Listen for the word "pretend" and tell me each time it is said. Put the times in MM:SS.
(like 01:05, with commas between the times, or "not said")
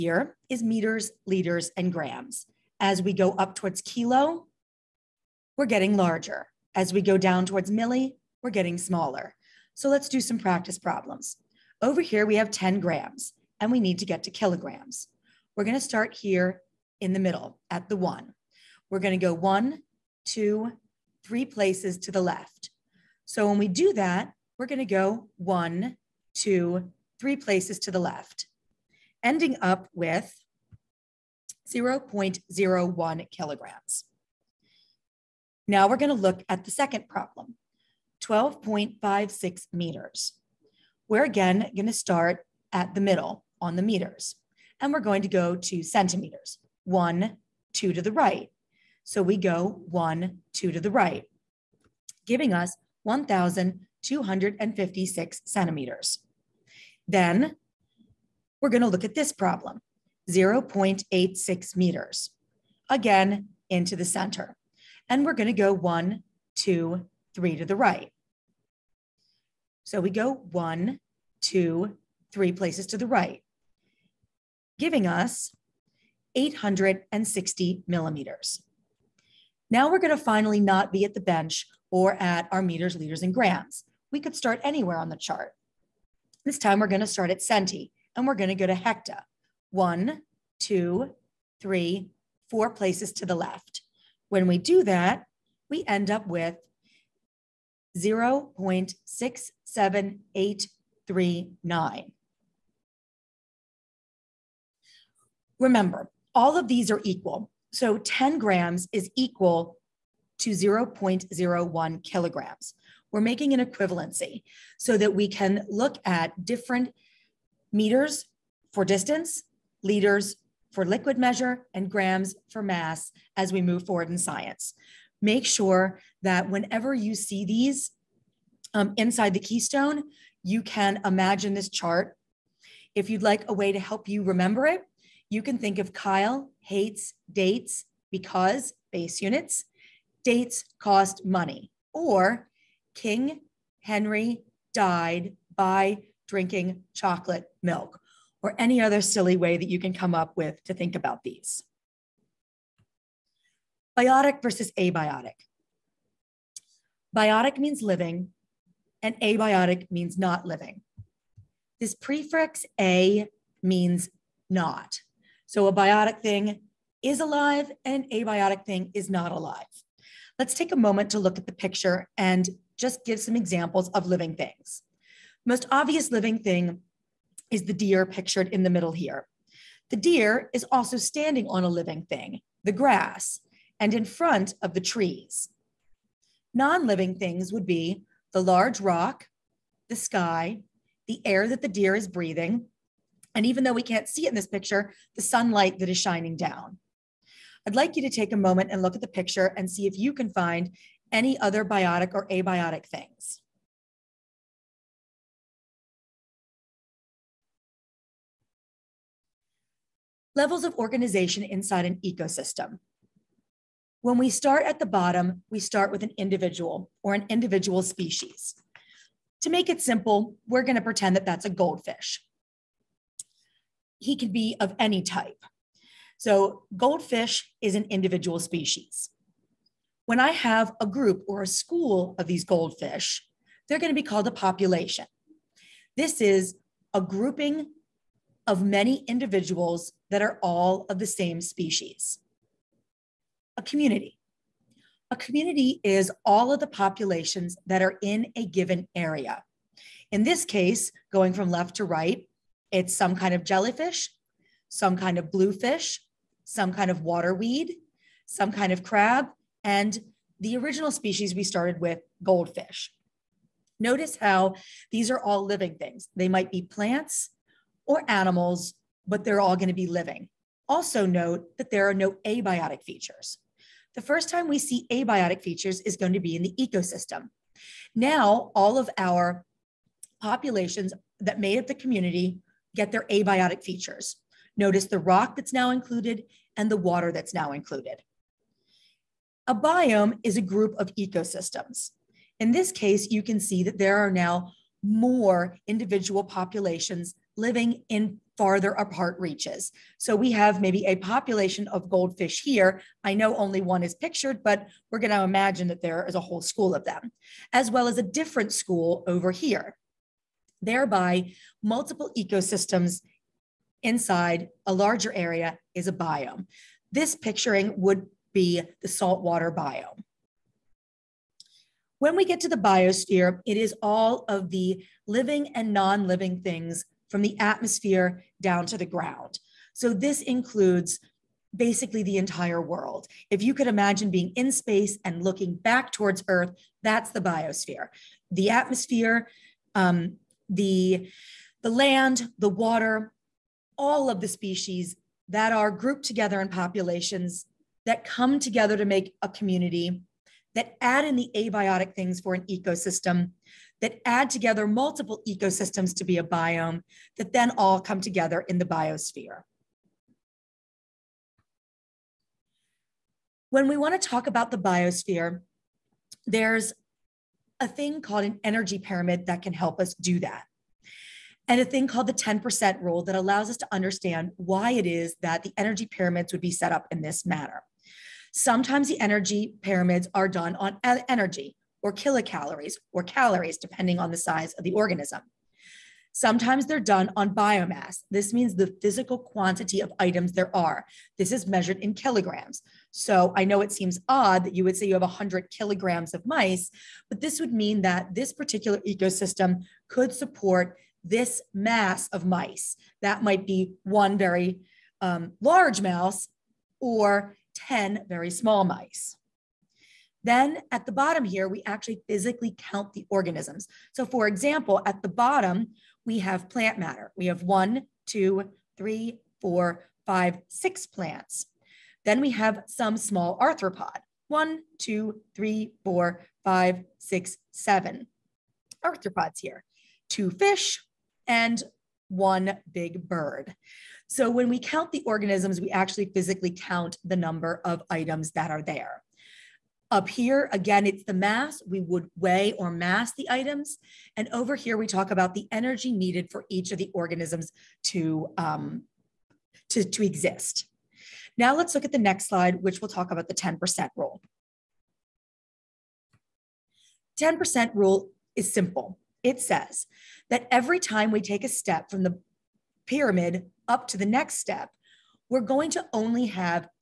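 03:40.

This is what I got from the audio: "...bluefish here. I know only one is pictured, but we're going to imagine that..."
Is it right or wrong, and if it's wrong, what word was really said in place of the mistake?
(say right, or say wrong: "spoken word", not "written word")
wrong: "goldfish", not "bluefish".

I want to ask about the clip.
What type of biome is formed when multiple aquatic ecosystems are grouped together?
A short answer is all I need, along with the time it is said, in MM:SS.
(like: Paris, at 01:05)
saltwater biome, at 05:18.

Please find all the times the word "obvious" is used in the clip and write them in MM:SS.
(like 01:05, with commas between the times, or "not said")
02:55.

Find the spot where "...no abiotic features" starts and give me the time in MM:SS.
04:31.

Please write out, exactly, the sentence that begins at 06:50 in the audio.
Then at the bottom here, we actually physically count the organisms.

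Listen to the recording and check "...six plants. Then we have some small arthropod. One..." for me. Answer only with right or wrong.
right.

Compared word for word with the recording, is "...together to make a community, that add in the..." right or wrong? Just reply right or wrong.
right.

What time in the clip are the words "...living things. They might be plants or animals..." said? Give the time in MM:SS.
04:25.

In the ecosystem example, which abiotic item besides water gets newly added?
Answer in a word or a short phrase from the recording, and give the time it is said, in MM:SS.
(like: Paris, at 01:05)
the rock, at 04:44.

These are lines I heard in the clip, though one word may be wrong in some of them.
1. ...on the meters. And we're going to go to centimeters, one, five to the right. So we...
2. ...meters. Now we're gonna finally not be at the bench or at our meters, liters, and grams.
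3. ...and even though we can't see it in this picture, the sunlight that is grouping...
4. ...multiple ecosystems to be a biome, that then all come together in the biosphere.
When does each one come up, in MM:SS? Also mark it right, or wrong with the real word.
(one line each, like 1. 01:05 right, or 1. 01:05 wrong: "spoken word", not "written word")
1. 00:43 wrong: "two", not "five"
2. 01:17 wrong: "millimeters", not "meters"
3. 03:13 wrong: "shining", not "grouping"
4. 05:54 right.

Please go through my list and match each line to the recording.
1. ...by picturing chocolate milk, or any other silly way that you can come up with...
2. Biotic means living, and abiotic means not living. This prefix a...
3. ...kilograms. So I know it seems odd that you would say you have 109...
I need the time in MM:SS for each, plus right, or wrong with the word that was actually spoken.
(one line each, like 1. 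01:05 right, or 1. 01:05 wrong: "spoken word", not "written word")
1. 02:25 wrong: "drinking", not "picturing"
2. 02:37 right
3. 06:31 wrong: "100", not "109".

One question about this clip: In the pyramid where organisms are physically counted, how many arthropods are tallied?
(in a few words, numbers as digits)
7.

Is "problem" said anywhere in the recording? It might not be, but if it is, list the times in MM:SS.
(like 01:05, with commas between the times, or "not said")
00:10, 00:37, 00:59.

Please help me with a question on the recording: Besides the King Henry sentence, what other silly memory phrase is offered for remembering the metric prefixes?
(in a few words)
Kyle hates dates.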